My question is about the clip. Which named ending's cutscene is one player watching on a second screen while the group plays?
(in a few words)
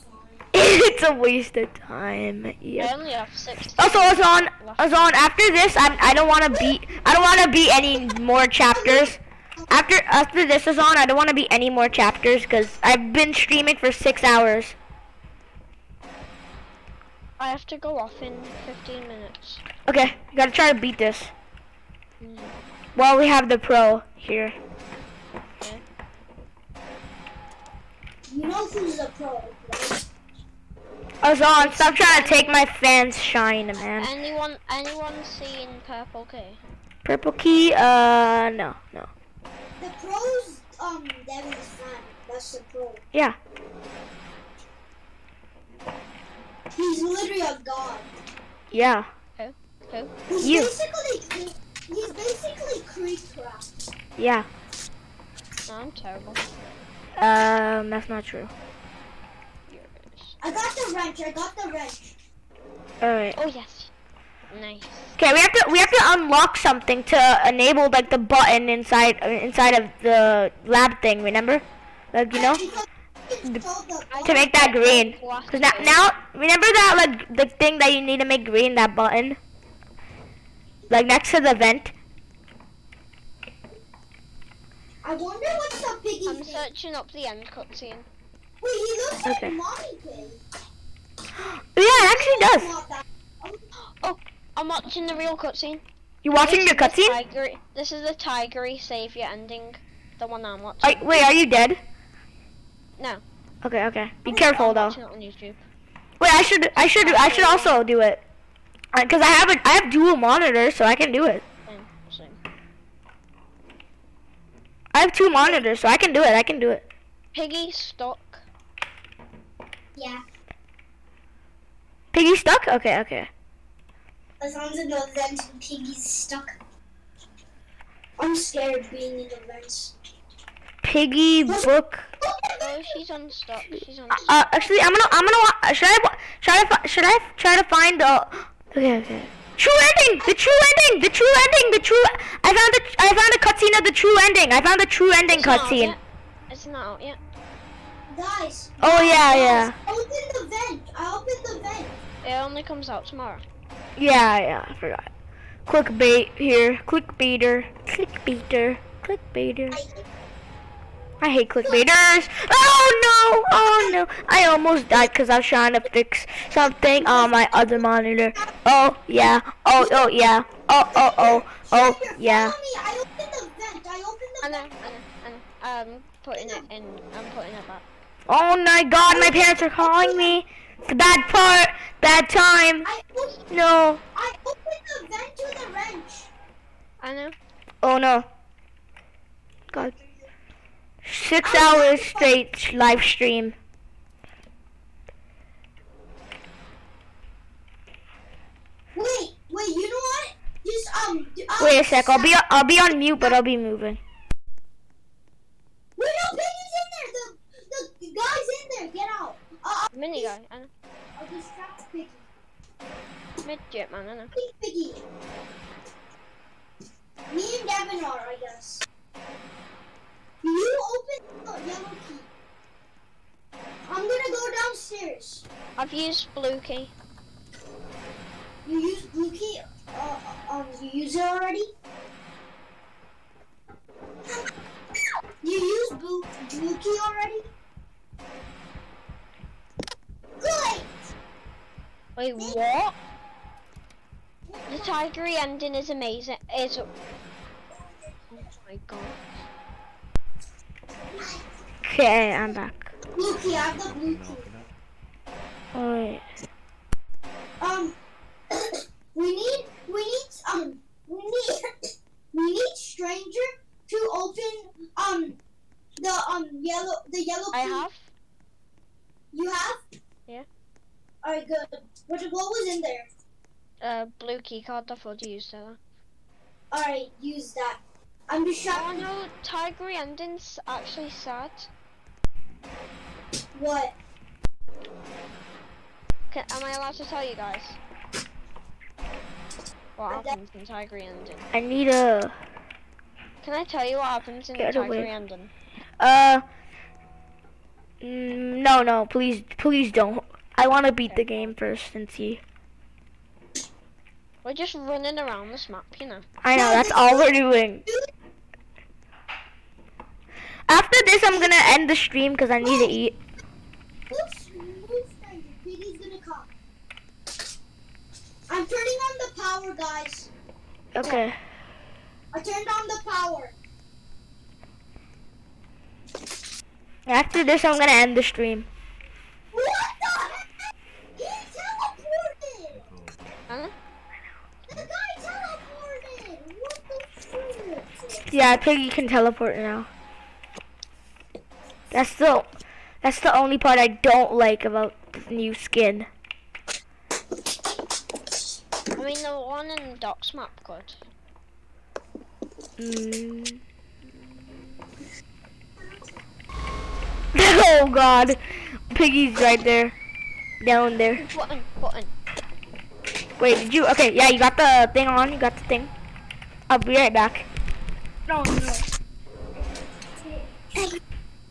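Tigry savior ending.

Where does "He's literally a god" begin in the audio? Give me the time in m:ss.
0:46.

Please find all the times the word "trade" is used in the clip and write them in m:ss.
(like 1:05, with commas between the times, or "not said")
not said.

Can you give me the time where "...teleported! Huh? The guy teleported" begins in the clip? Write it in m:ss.
5:32.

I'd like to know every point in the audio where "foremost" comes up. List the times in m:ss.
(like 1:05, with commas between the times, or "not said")
not said.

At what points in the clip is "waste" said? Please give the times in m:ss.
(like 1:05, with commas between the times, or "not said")
0:01.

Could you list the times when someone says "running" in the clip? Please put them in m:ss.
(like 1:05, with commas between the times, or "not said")
5:04.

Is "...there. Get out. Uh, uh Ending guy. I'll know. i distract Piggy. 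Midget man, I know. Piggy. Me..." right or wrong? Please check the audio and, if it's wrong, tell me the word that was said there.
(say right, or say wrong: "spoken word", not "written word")
wrong: "Mini", not "Ending".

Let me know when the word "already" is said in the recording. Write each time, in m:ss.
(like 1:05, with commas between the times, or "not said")
3:51, 3:57.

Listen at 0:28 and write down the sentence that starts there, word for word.
You know who's the pro, right?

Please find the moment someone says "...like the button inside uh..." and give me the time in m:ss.
1:07.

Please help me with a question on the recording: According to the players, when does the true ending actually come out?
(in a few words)
Tomorrow.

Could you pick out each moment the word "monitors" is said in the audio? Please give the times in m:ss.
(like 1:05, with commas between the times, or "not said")
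1:50, 1:55, 2:47.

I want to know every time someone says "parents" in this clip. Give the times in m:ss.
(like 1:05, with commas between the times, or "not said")
2:59.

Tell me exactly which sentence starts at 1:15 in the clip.
Cause now, now, remember that like the thing that you need to make green, that button, like next to the vent.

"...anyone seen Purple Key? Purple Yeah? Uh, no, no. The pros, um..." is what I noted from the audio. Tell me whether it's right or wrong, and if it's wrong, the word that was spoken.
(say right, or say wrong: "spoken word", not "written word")
wrong: "Key", not "Yeah".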